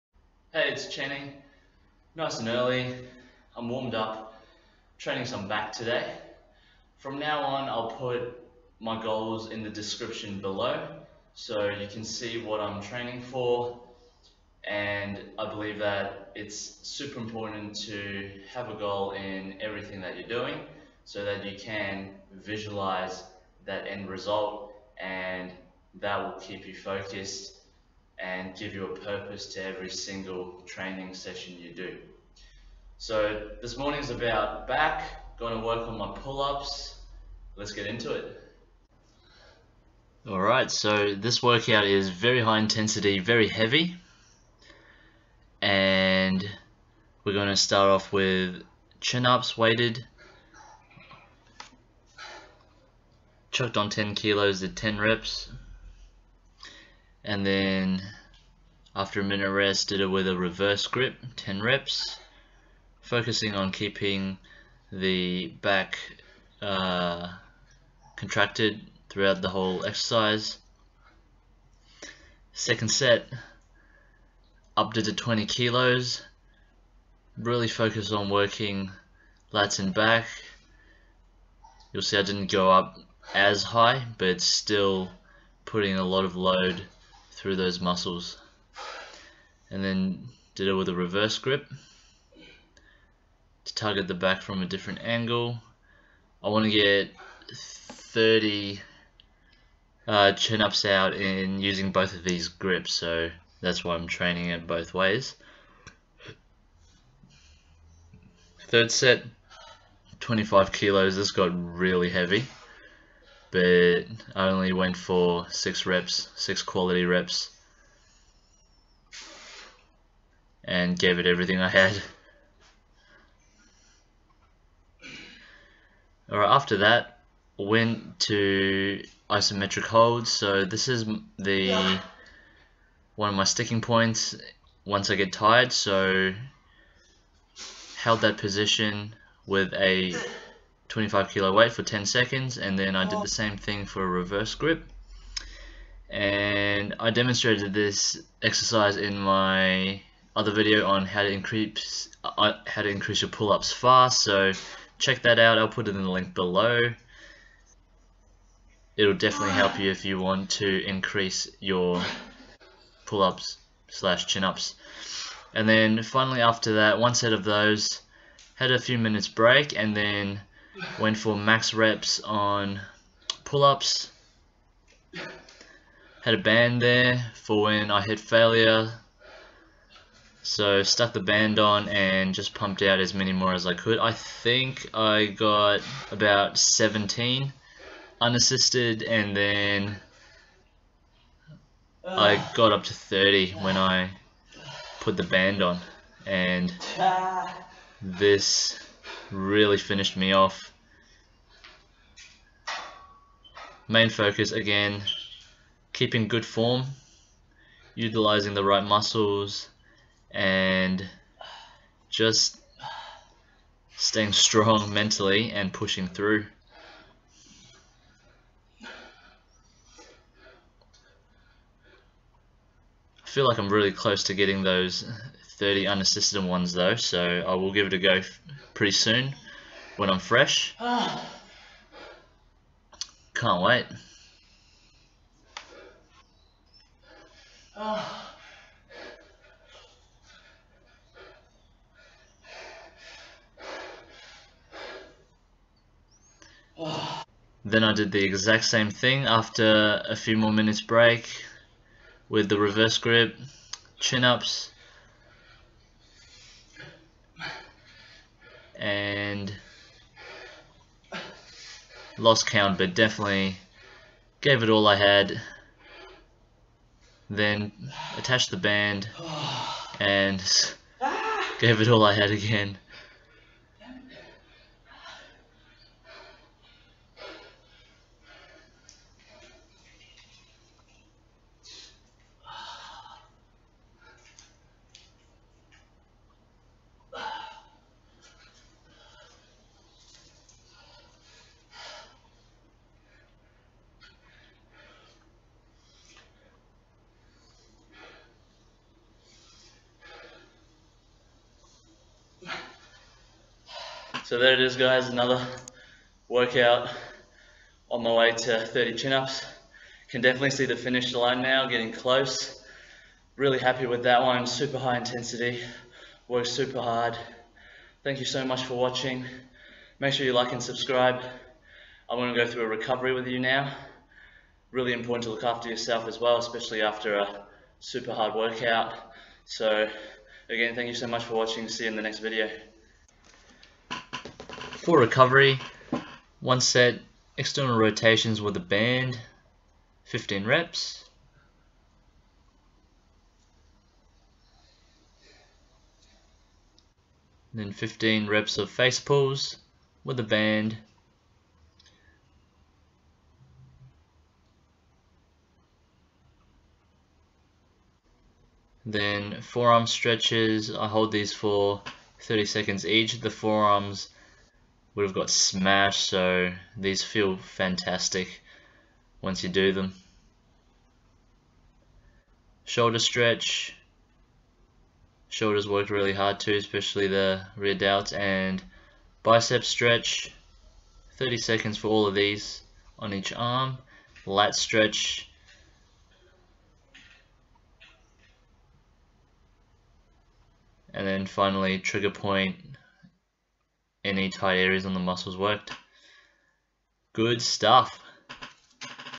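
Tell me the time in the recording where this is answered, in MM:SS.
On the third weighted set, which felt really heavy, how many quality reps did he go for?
01:56.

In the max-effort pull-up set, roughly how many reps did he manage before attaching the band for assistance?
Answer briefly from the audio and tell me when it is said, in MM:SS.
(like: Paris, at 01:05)
17, at 03:06.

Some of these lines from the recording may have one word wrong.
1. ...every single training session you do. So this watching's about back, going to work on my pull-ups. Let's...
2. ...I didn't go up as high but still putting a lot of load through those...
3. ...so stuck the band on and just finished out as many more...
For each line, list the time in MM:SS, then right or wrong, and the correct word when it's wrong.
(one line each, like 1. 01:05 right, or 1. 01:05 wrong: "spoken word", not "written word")
1. 00:29 wrong: "morning", not "watching"
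2. 01:22 right
3. 03:00 wrong: "pumped", not "finished".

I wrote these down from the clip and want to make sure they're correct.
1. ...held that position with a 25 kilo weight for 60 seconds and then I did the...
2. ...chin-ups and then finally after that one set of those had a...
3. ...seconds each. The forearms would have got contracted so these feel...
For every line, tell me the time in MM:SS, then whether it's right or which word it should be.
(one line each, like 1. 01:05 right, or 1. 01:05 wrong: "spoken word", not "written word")
1. 02:17 wrong: "10", not "60"
2. 02:44 right
3. 06:02 wrong: "smashed", not "contracted".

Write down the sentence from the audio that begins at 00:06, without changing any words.
From now on, I'll put my goals in the description below so you can see what I'm training for.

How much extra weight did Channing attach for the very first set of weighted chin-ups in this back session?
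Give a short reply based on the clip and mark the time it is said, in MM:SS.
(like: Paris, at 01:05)
10 kilos, at 00:53.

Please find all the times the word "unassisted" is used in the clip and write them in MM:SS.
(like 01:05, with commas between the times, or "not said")
03:08, 03:45.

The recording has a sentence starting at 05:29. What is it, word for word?
So again, thank you so much for watching.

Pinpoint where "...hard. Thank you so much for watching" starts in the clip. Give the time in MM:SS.
05:16.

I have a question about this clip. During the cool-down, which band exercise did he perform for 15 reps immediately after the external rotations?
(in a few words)
face pulls.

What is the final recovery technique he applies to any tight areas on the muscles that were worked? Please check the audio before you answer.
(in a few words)
trigger point.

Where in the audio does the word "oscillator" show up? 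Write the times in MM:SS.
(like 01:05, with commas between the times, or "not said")
not said.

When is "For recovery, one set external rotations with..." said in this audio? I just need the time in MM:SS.
05:34.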